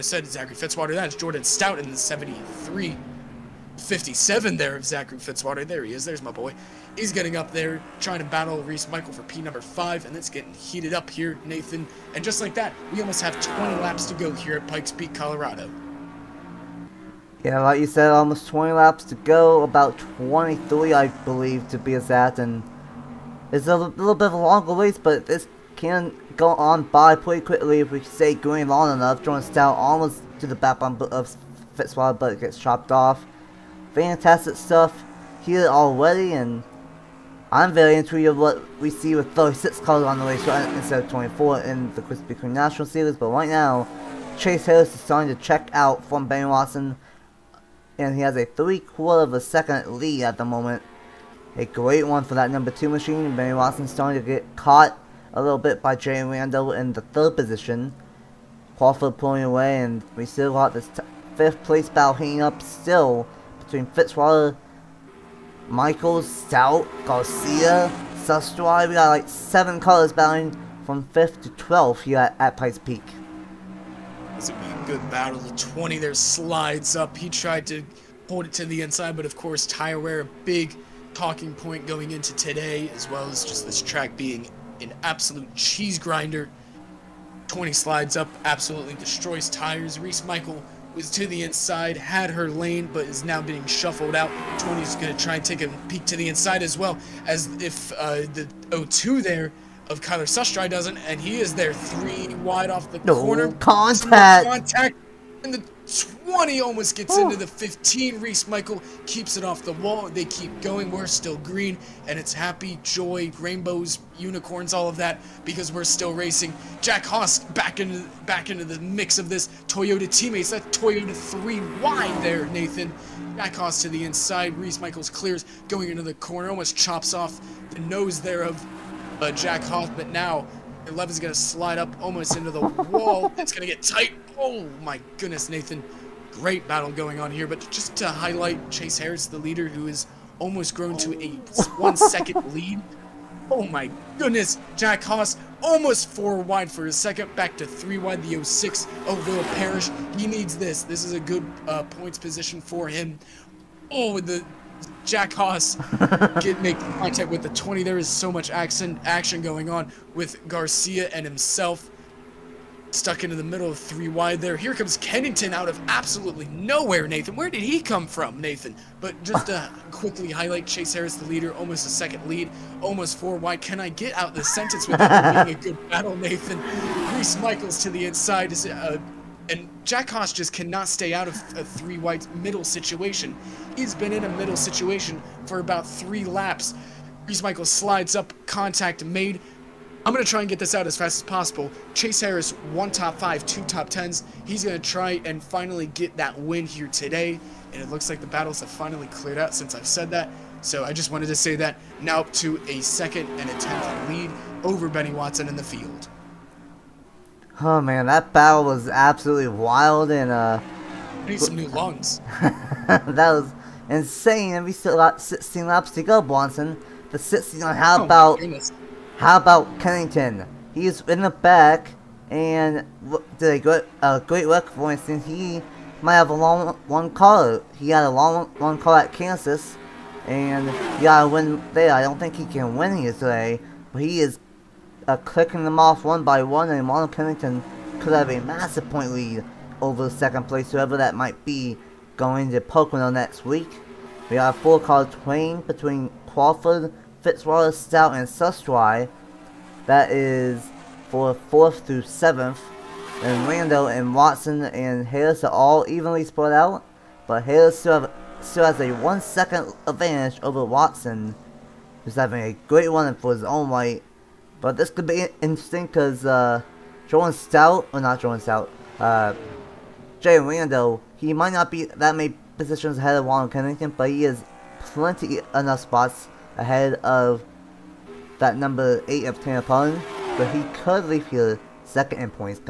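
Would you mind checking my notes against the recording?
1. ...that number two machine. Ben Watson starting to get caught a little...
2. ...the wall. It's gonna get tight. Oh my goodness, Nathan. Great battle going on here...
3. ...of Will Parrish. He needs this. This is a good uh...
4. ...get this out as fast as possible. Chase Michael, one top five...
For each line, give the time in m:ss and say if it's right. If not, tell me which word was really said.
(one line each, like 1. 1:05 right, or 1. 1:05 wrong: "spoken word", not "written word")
1. 0:52 right
2. 2:12 right
3. 2:29 right
4. 3:10 wrong: "Harris", not "Michael".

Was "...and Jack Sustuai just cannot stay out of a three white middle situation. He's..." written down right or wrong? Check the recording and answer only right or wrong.
wrong.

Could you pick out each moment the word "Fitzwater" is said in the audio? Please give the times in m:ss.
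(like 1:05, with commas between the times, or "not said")
0:00, 0:05, 0:31, 1:03, 4:07.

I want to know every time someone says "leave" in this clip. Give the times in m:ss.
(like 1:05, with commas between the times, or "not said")
4:41.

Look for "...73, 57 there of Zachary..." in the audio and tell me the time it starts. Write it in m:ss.
0:01.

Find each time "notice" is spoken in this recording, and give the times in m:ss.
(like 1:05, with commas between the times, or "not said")
not said.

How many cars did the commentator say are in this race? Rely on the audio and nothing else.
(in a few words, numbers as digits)
36.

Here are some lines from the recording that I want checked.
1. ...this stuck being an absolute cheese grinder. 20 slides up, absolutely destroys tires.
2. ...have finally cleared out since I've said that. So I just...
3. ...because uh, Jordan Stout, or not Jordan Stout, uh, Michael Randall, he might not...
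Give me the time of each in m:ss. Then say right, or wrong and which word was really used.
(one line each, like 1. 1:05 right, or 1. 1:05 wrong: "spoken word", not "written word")
1. 1:23 wrong: "track", not "stuck"
2. 3:18 right
3. 4:25 wrong: "Jay", not "Michael".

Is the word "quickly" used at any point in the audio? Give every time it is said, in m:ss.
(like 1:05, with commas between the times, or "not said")
0:27, 2:49.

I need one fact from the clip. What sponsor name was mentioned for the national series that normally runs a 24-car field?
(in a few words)
Krispy Kreme.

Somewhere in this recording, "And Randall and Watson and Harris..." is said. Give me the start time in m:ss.
4:13.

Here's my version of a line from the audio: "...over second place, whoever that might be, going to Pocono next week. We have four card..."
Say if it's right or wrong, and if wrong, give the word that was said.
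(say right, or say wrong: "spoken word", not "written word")
right.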